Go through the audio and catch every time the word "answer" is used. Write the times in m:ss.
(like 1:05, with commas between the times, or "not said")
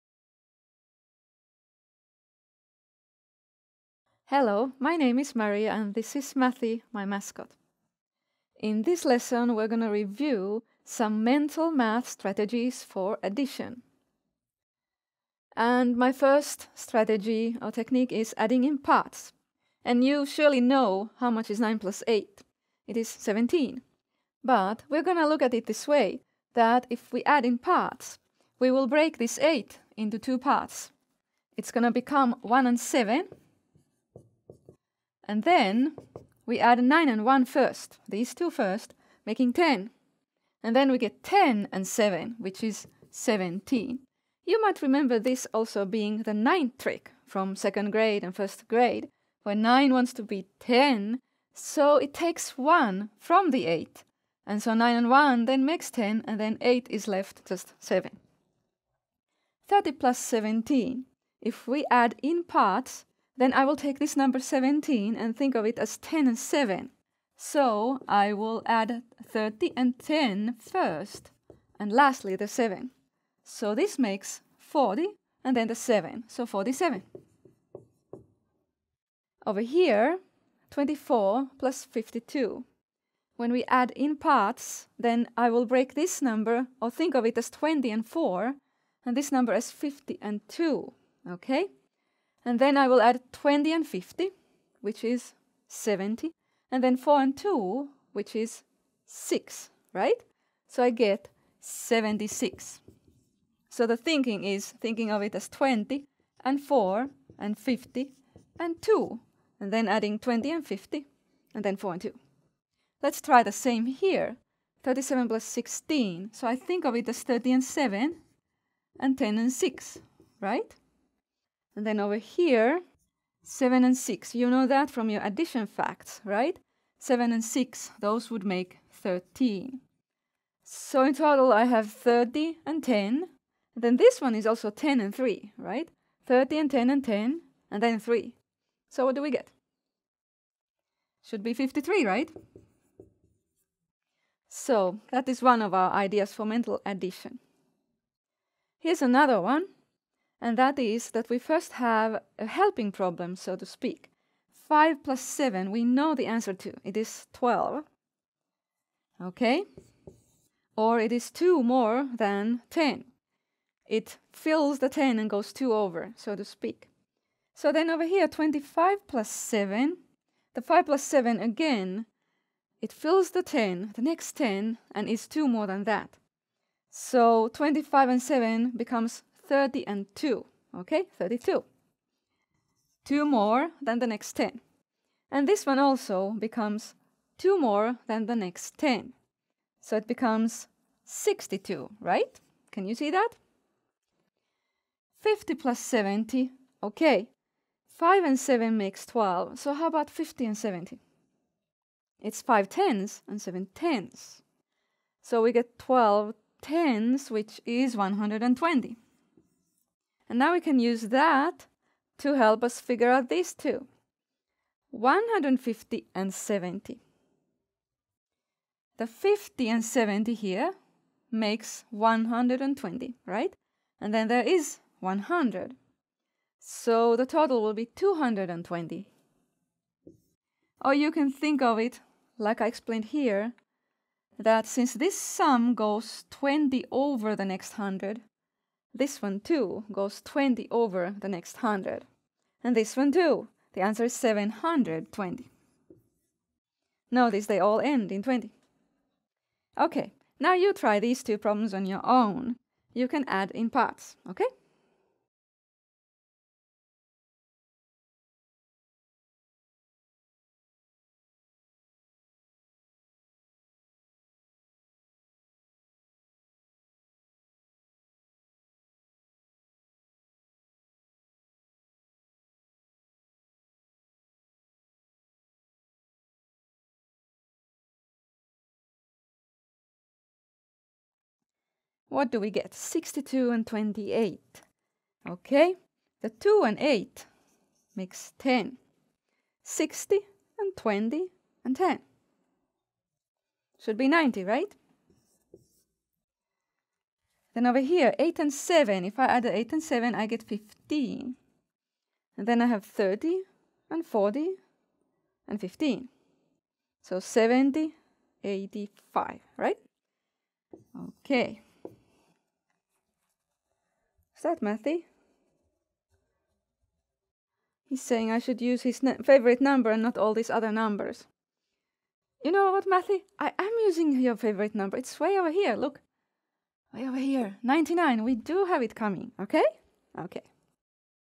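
2:36, 4:03.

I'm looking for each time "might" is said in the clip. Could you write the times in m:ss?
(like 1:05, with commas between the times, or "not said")
0:44.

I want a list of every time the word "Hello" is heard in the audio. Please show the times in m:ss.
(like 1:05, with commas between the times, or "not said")
0:04.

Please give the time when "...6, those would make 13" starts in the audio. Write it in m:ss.
2:07.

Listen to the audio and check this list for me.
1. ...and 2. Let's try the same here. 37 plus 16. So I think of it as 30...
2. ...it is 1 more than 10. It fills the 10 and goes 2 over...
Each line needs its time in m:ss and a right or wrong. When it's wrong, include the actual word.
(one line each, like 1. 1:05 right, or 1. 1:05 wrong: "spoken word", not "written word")
1. 1:51 right
2. 2:40 wrong: "2", not "1".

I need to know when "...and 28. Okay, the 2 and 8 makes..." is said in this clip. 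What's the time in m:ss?
4:43.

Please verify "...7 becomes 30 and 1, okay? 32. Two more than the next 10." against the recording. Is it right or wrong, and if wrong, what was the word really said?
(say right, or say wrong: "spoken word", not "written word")
wrong: "2", not "1".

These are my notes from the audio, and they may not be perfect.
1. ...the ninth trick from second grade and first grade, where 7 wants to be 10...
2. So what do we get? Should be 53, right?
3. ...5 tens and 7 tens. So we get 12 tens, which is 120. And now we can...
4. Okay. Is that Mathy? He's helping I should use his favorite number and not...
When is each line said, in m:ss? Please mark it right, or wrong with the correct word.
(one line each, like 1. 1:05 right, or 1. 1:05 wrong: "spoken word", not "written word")
1. 0:46 wrong: "9", not "7"
2. 2:18 right
3. 3:22 right
4. 5:11 wrong: "saying", not "helping".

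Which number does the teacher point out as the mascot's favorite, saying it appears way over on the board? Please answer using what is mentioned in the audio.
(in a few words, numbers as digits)
99.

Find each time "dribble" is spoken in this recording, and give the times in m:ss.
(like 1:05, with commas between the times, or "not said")
not said.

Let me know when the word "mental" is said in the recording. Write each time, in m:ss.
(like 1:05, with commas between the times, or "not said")
0:11, 2:26.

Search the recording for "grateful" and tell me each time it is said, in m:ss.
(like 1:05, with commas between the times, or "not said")
not said.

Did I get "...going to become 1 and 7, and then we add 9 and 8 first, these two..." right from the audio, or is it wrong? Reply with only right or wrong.
wrong.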